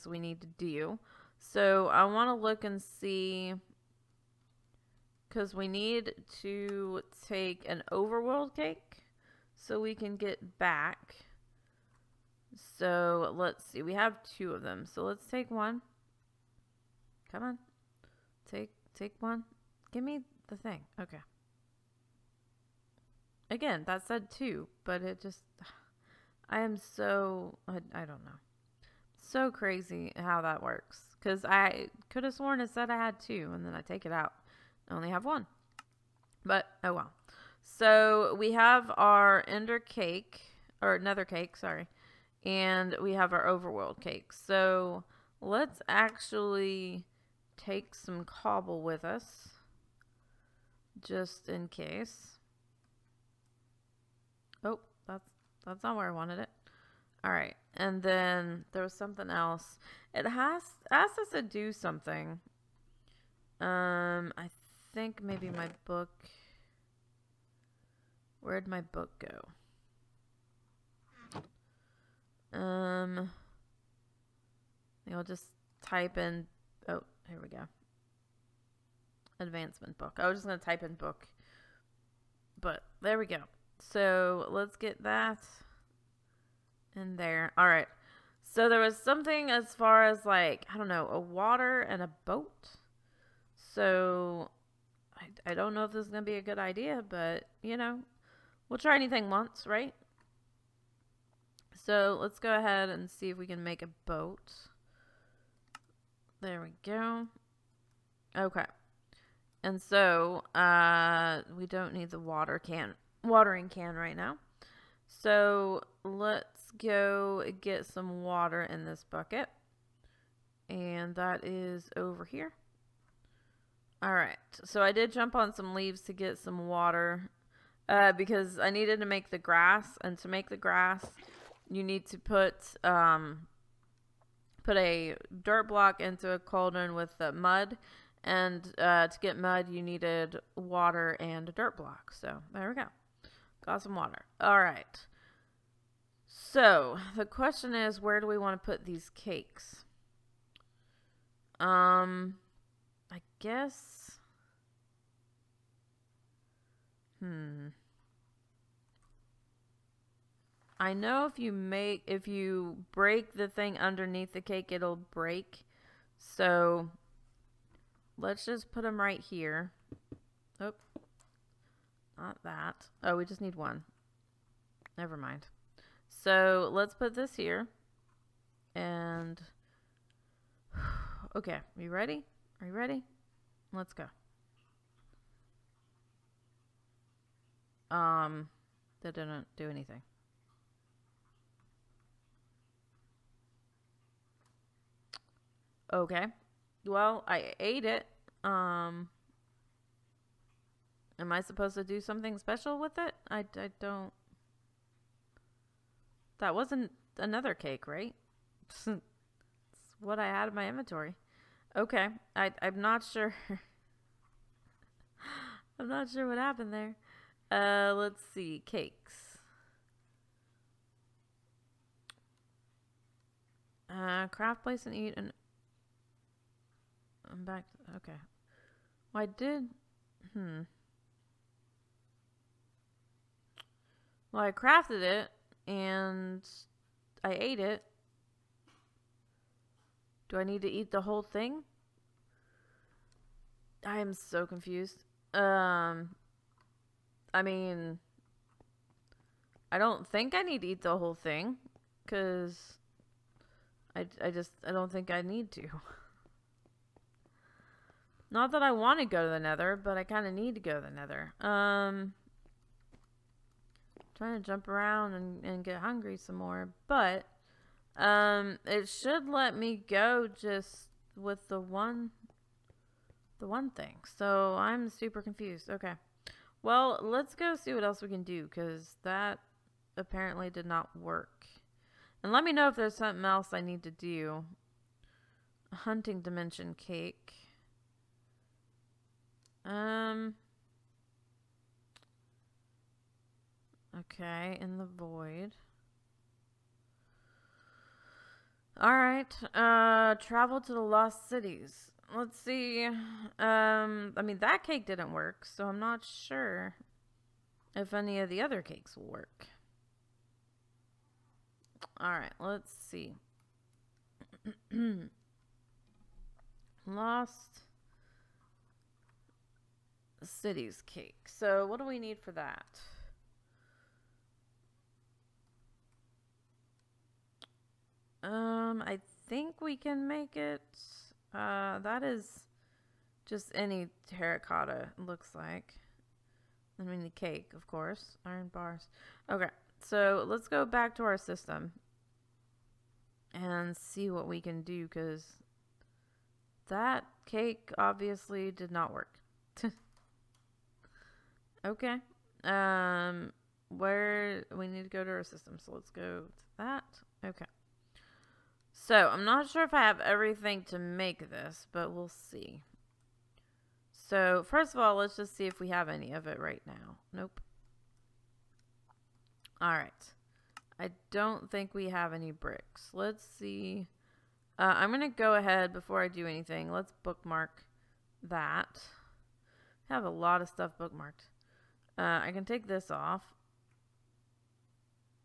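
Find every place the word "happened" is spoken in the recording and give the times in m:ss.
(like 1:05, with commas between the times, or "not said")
3:36.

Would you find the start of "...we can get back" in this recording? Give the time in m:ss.
0:09.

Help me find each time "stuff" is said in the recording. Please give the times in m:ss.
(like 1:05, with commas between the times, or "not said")
6:20.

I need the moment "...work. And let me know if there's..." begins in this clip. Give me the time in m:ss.
4:40.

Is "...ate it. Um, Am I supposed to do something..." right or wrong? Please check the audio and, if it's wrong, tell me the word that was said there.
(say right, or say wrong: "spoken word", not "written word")
right.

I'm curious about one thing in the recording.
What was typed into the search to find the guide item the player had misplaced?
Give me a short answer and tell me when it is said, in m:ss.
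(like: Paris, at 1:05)
Advancement book, at 1:19.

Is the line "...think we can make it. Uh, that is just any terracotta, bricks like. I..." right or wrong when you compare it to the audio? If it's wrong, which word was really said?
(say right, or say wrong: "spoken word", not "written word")
wrong: "looks", not "bricks".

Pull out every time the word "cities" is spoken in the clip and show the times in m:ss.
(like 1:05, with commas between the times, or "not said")
5:01, 5:20.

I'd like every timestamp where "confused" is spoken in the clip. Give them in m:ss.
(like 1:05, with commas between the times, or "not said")
4:04, 4:35.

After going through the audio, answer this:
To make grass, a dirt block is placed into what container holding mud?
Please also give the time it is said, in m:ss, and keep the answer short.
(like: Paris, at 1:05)
Cauldron, at 2:16.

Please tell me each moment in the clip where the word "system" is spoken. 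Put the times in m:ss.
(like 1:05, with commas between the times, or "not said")
5:41, 5:55.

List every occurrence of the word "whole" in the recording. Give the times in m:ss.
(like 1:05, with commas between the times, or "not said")
4:01, 4:10.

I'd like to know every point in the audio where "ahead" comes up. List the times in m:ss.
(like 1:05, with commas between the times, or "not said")
1:42, 6:15.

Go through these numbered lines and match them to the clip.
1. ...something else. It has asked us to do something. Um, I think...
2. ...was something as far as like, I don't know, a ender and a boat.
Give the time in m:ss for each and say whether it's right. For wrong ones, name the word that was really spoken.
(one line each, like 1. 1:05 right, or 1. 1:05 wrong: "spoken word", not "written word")
1. 0:58 right
2. 1:28 wrong: "water", not "ender".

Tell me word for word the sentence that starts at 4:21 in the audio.
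Um trying to jump around and, and get hungry some more.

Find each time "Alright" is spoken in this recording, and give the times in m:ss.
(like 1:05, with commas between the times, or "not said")
4:58, 5:12, 6:09.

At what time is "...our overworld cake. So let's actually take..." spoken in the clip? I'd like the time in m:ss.
0:43.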